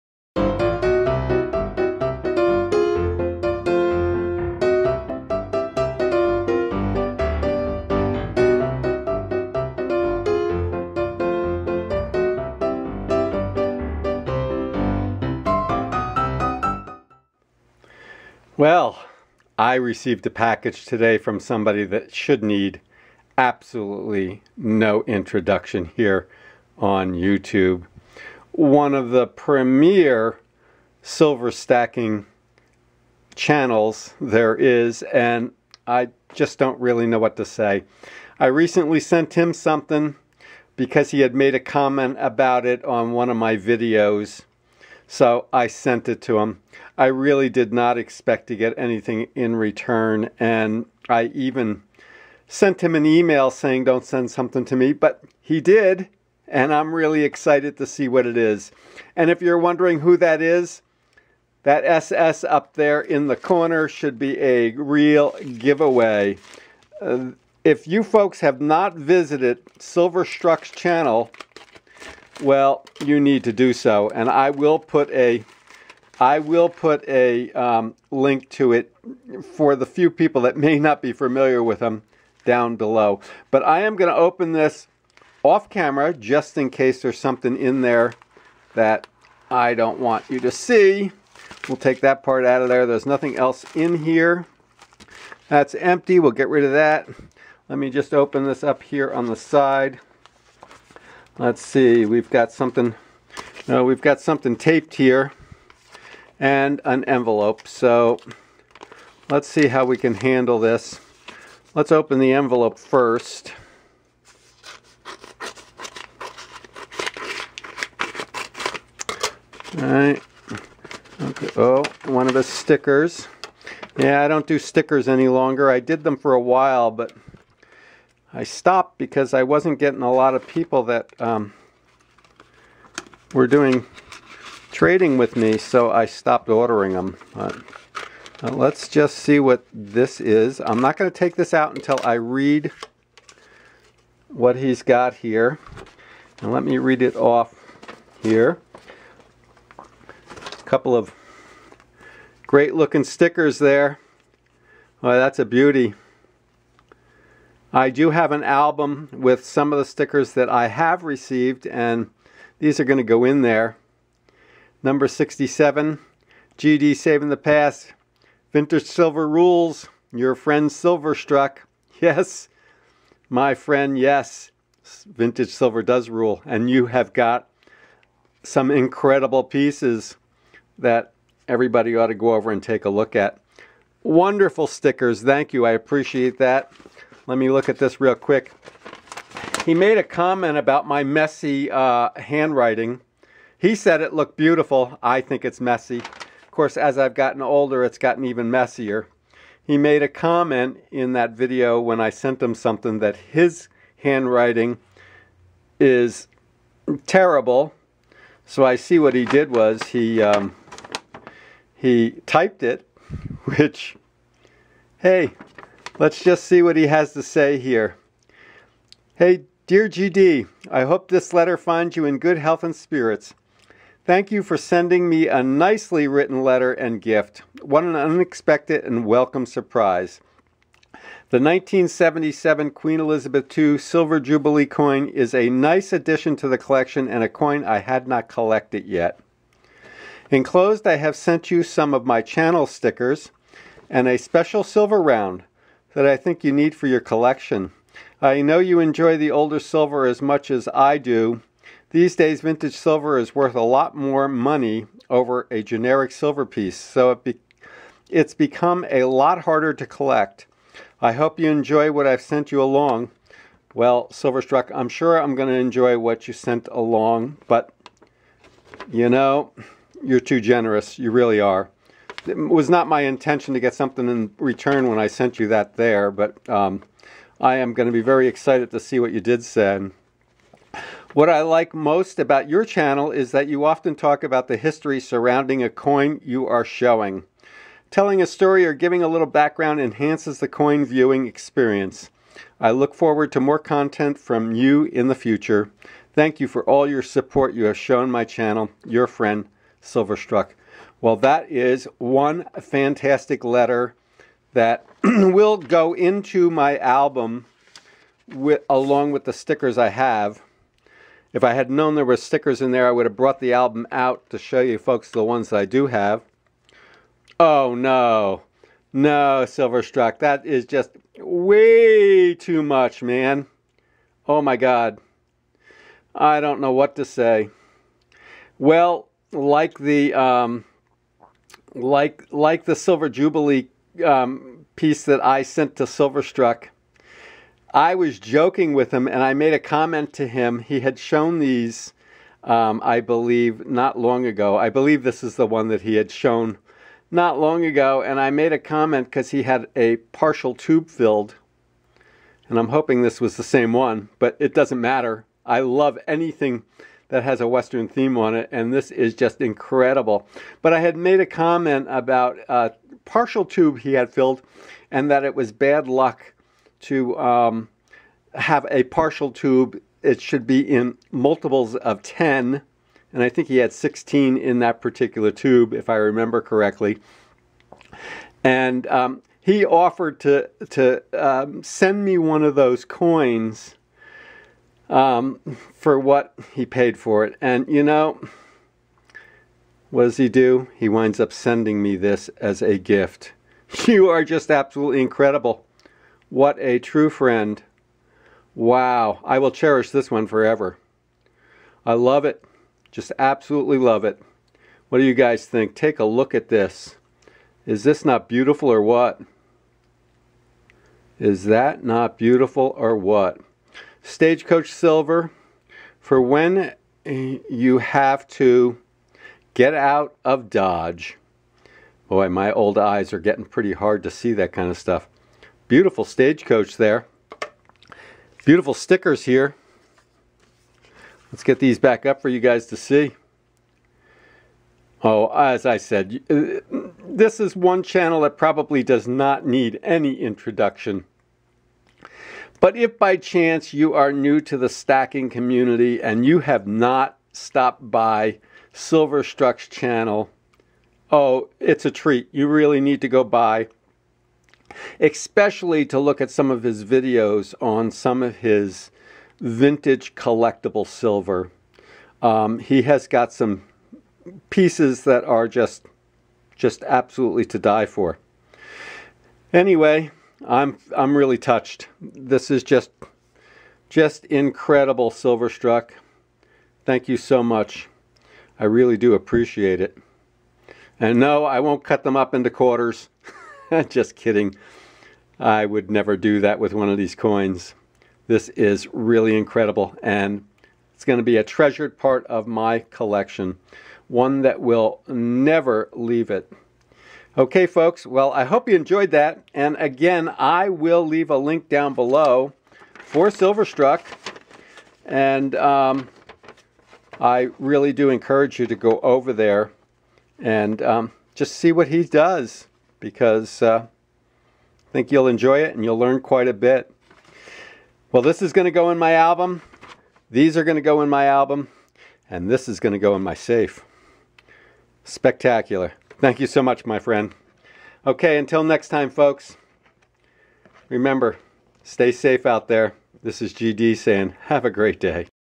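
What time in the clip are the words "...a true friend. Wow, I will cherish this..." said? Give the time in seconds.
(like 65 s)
396 s.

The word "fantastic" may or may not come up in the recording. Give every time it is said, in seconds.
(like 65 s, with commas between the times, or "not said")
302 s.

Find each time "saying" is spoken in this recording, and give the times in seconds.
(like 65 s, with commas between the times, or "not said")
53 s, 533 s.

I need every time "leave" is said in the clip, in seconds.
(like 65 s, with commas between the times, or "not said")
495 s, 501 s.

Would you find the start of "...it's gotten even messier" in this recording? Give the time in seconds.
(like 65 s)
197 s.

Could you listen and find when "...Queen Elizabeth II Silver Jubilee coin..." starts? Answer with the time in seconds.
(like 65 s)
232 s.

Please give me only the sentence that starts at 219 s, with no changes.
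Hey, dear GD, I hope this letter finds you in good health and spirits.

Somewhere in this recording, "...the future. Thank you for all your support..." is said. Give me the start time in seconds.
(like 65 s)
295 s.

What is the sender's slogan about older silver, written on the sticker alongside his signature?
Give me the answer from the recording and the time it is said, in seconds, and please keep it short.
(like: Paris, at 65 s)
Vintage Silver Rules, at 168 s.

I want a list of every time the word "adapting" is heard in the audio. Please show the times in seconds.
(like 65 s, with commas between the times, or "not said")
not said.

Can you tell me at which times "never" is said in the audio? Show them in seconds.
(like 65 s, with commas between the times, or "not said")
485 s, 495 s.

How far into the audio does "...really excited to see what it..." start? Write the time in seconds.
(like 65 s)
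56 s.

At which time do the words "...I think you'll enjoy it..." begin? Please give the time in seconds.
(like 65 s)
513 s.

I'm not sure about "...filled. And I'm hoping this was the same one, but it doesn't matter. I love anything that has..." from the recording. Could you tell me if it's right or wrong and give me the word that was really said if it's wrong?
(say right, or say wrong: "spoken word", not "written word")
right.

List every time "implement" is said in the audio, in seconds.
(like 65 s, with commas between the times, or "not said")
not said.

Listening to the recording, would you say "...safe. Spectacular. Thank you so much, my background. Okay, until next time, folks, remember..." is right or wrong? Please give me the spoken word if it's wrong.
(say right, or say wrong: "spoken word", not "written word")
wrong: "friend", not "background".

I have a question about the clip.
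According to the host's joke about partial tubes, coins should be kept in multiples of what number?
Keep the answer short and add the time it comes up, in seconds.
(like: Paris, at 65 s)
10, at 371 s.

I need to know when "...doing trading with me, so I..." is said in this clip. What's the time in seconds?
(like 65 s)
133 s.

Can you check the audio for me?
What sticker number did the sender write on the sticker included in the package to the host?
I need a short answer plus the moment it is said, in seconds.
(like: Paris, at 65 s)
67, at 164 s.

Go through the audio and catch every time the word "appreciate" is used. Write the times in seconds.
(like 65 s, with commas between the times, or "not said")
185 s, 479 s.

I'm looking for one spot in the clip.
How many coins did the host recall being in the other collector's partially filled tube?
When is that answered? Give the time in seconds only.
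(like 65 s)
373 s.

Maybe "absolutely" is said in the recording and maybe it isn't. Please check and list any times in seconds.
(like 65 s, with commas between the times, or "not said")
23 s, 394 s, 403 s, 466 s.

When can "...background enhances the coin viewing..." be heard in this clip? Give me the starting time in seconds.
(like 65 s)
289 s.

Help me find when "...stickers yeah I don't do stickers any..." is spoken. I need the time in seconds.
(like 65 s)
122 s.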